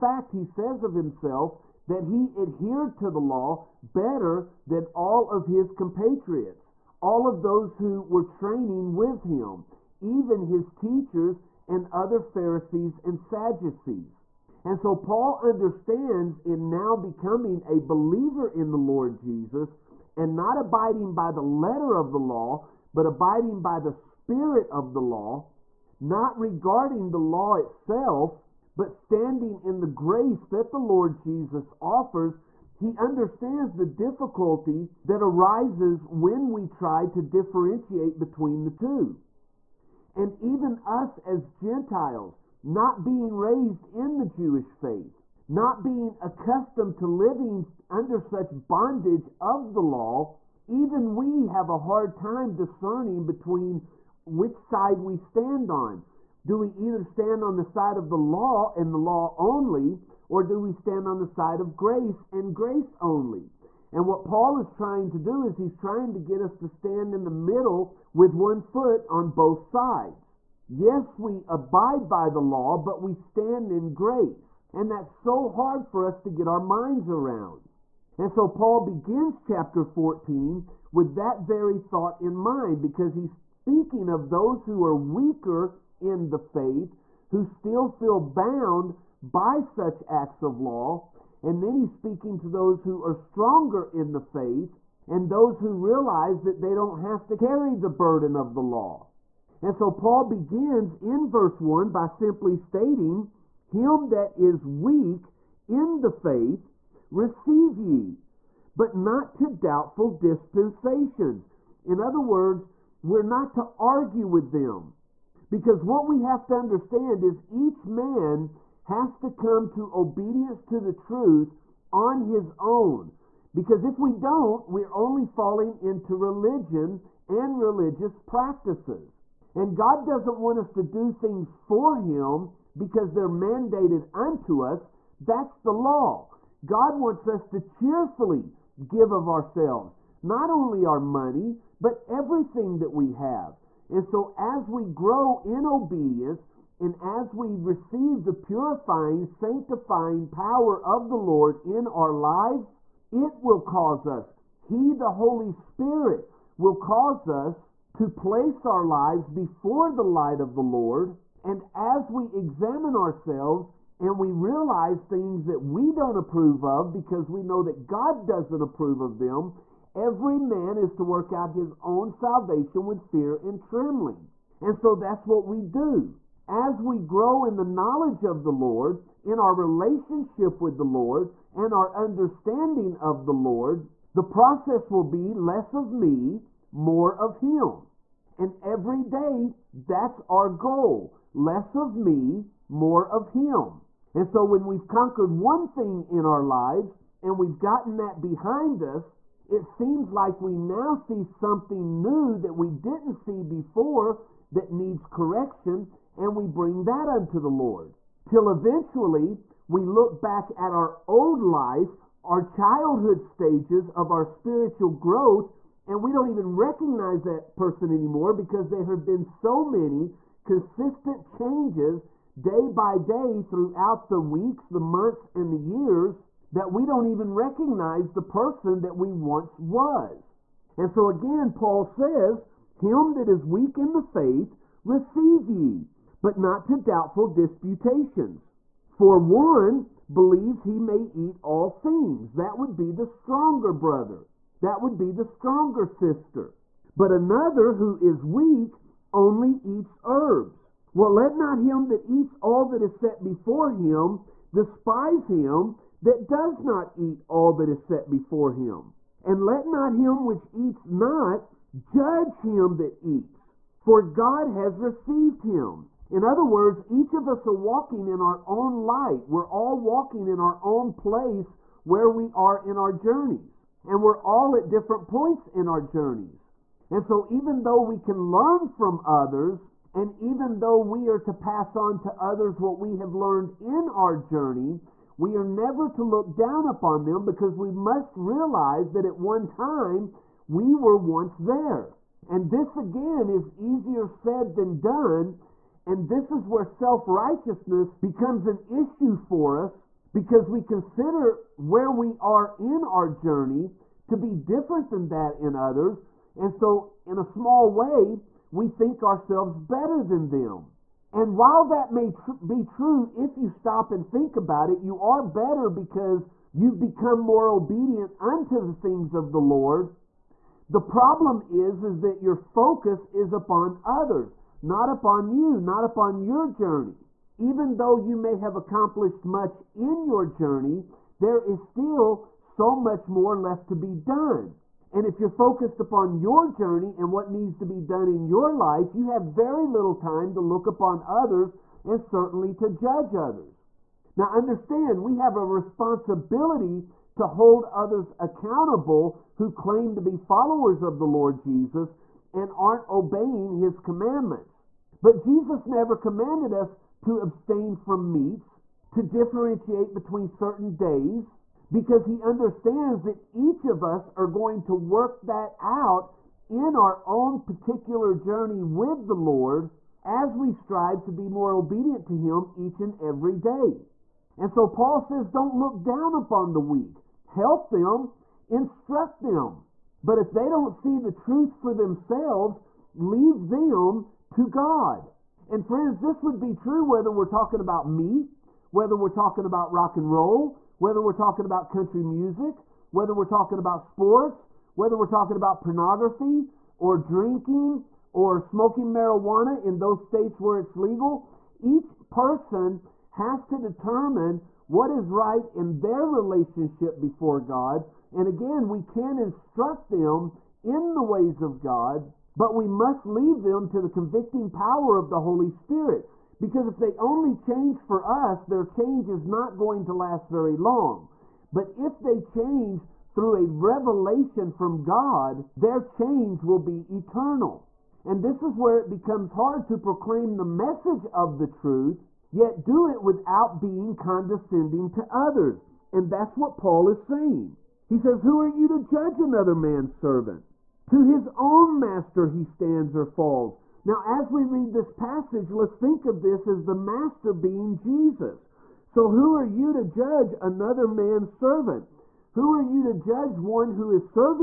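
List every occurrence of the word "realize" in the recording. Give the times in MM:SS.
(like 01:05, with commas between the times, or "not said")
01:35, 02:44, 04:48.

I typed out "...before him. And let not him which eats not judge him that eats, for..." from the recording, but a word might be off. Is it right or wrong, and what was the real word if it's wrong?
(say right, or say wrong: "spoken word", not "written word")
right.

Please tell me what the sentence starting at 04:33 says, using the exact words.
And we're all at different points in our journeys.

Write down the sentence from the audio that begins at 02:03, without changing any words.
Because if we don't, we're only falling into religion and religious practices.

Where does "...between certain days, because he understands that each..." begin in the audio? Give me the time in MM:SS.
05:59.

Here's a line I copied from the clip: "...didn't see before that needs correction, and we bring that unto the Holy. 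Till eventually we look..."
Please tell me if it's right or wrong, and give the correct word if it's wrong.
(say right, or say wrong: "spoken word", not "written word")
wrong: "Lord", not "Holy".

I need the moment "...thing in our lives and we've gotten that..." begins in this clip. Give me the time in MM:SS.
03:15.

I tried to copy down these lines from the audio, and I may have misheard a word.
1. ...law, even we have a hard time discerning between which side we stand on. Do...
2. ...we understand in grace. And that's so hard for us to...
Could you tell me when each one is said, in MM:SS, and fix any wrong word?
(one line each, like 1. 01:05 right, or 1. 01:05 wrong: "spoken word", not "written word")
1. 00:49 right
2. 01:13 wrong: "stand", not "understand".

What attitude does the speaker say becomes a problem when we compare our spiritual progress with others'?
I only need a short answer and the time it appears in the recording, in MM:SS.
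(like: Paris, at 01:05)
Self righteousness, at 04:56.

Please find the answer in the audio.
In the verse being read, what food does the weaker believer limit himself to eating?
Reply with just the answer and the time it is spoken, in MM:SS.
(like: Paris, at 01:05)
Herbs, at 04:10.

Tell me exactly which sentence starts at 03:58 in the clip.
For one believes he may eat all things.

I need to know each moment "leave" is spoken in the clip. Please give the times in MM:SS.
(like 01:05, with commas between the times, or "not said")
06:22, 06:53.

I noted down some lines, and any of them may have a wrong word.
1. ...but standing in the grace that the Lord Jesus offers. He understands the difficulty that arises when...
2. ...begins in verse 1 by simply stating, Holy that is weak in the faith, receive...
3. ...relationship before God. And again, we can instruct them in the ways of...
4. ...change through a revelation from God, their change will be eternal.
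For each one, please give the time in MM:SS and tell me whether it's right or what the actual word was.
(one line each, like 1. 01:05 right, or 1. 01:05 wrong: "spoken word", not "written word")
1. 00:28 right
2. 01:40 wrong: "Him", not "Holy"
3. 06:46 right
4. 07:02 right.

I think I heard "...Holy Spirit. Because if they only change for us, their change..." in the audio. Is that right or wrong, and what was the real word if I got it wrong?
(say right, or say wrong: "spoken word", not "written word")
right.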